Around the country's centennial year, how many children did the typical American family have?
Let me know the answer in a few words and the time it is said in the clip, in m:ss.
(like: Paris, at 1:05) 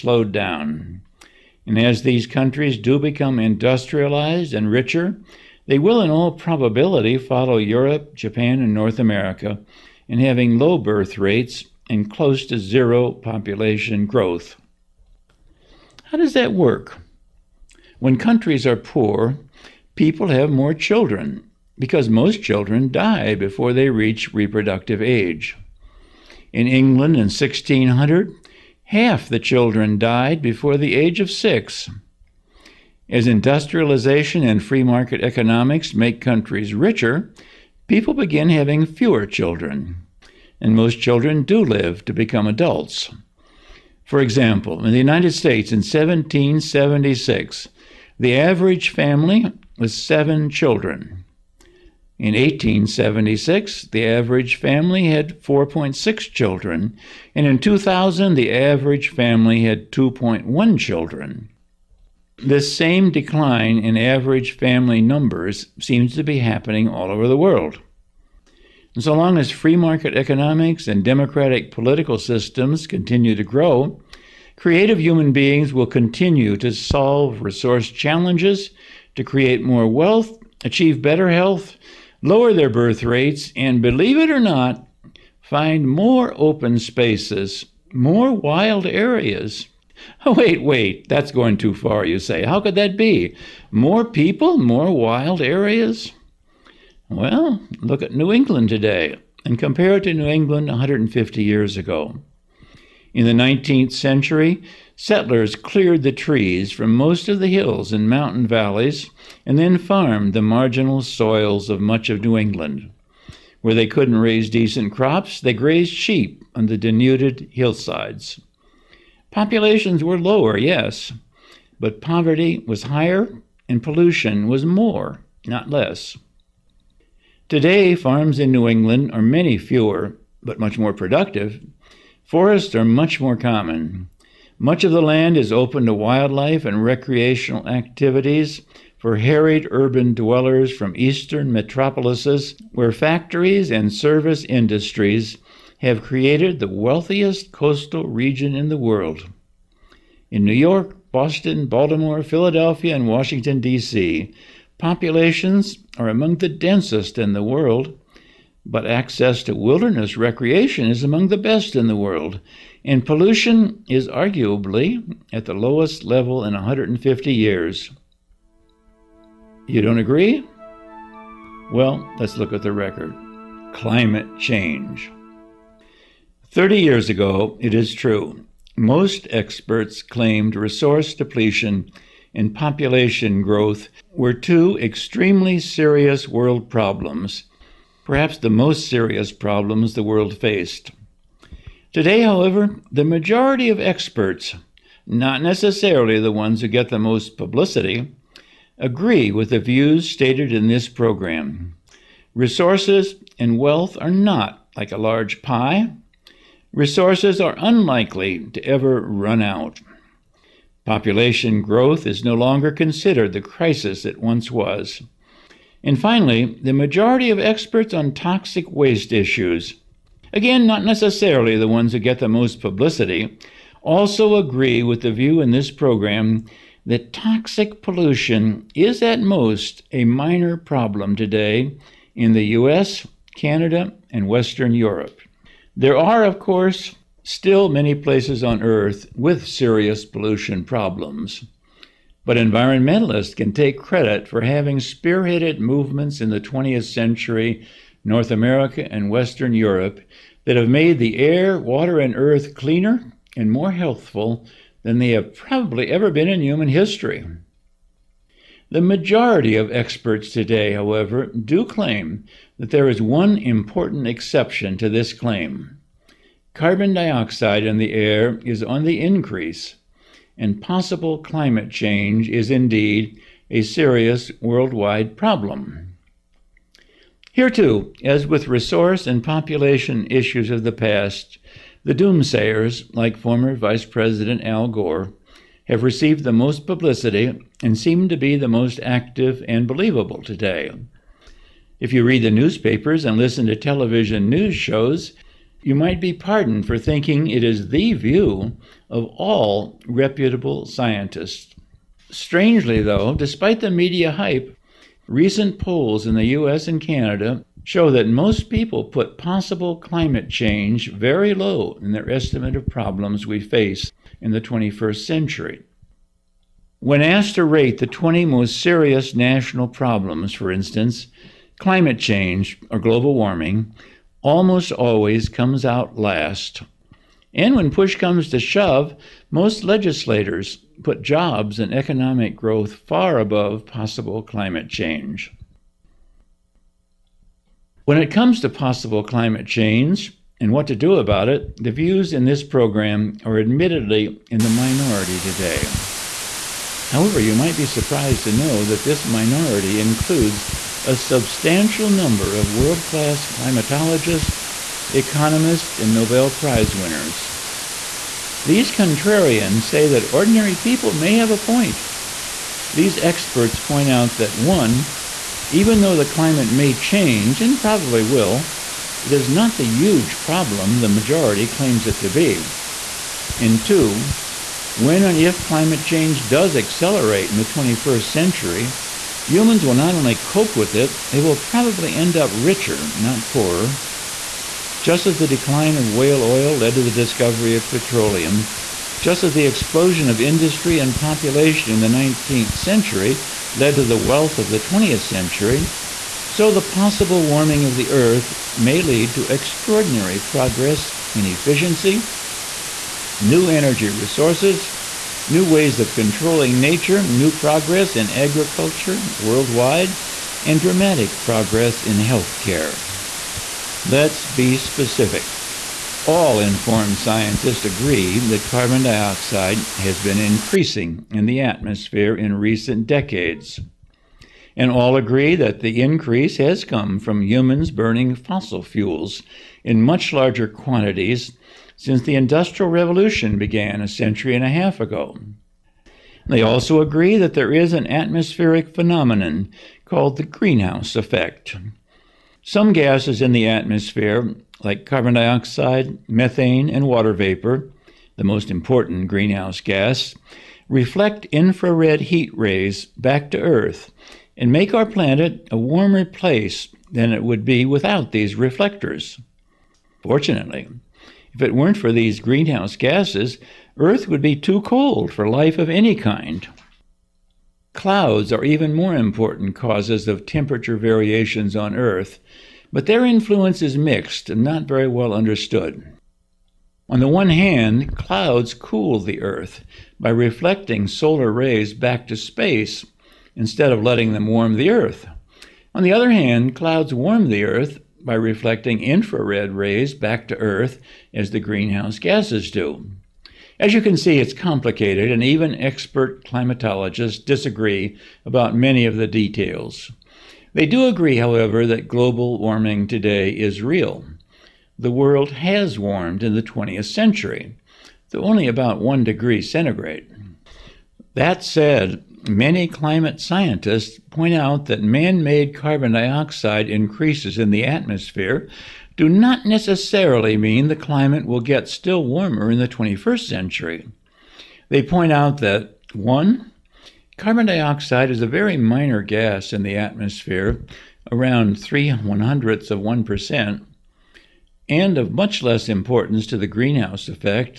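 4.6, at 0:55.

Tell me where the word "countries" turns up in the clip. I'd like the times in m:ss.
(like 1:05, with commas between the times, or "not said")
0:02, 0:18, 0:36.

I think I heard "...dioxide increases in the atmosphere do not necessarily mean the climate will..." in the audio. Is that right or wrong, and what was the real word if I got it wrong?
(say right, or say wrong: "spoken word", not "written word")
right.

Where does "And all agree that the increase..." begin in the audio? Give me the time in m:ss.
7:04.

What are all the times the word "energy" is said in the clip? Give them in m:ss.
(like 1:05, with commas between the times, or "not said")
6:43.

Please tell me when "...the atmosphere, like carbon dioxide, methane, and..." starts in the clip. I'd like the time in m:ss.
7:23.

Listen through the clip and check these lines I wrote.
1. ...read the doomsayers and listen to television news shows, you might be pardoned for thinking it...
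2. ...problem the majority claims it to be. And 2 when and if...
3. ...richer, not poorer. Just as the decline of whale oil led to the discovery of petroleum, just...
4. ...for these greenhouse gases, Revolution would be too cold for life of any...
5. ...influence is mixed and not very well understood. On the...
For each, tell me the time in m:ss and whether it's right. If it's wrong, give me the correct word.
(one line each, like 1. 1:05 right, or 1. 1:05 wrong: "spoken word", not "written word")
1. 4:52 wrong: "newspapers", not "doomsayers"
2. 6:10 right
3. 6:22 right
4. 7:41 wrong: "Earth", not "Revolution"
5. 7:53 right.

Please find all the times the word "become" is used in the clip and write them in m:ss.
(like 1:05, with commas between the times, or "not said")
0:02, 0:42.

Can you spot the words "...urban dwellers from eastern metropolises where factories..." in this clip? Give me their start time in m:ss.
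2:19.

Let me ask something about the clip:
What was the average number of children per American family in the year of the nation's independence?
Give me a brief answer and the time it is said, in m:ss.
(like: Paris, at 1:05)
7, at 0:49.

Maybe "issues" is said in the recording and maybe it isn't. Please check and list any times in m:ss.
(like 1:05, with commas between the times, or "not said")
3:39, 4:40.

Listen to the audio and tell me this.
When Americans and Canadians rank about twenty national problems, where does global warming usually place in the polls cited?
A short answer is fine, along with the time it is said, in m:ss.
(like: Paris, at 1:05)
last, at 5:25.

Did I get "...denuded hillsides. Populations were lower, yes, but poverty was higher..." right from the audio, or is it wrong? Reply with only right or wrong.
right.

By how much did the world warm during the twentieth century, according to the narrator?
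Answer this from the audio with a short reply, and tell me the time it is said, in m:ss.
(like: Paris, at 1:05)
about 1 degree centigrade, at 8:28.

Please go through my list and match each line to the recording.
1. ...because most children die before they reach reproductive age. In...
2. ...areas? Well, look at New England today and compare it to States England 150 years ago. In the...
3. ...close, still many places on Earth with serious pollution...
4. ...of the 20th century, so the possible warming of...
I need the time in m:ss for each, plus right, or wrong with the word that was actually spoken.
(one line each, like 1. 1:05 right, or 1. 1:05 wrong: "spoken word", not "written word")
1. 0:21 right
2. 1:35 wrong: "New", not "States"
3. 3:56 wrong: "course", not "close"
4. 6:34 right.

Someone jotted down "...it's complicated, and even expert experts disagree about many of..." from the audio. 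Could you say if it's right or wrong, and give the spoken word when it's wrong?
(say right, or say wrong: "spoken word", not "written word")
wrong: "climatologists", not "experts".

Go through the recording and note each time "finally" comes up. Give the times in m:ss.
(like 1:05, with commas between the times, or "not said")
3:35.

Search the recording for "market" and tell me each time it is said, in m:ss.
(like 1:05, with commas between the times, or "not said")
0:34, 1:09.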